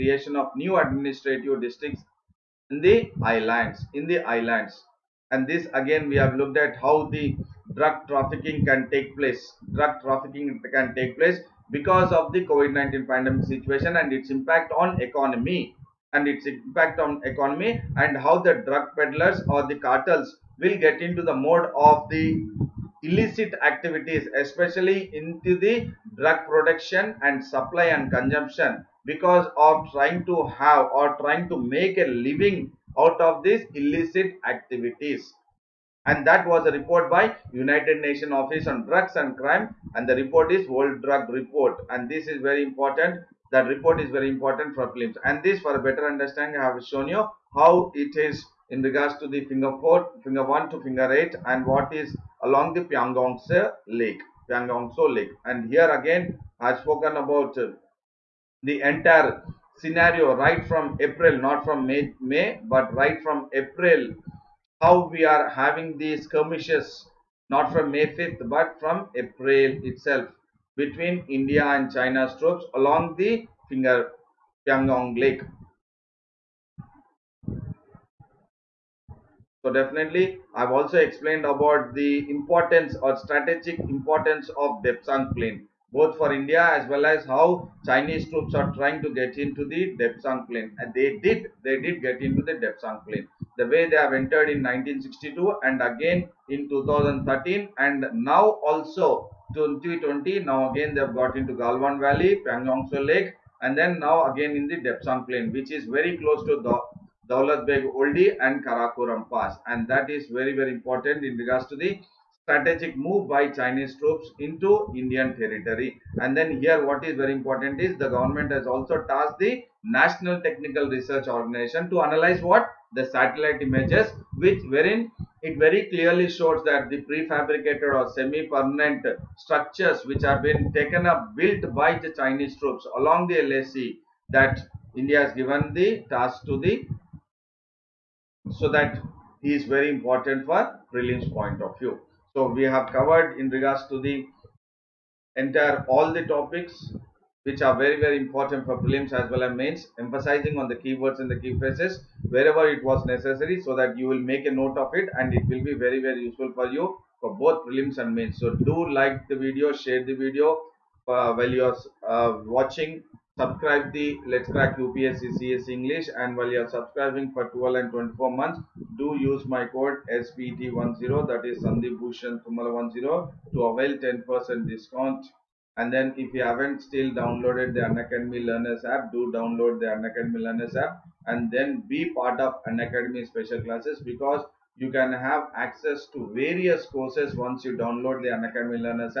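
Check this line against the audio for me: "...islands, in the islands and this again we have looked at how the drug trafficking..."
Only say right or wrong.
right.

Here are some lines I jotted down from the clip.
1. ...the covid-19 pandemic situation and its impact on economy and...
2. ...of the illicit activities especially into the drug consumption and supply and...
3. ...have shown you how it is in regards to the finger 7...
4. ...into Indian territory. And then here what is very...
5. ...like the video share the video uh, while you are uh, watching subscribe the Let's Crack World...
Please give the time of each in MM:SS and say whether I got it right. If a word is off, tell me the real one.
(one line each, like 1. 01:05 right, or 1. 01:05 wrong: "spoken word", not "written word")
1. 00:12 right
2. 00:21 wrong: "production", not "consumption"
3. 00:46 wrong: "4", not "7"
4. 01:54 right
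5. 02:38 wrong: "UPSC", not "World".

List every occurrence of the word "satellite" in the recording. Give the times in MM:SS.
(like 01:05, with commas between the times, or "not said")
02:03.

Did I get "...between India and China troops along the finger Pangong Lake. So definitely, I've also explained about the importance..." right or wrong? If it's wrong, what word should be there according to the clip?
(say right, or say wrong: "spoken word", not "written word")
right.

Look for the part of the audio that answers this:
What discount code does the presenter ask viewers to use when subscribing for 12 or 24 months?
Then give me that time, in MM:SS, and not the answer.
02:50.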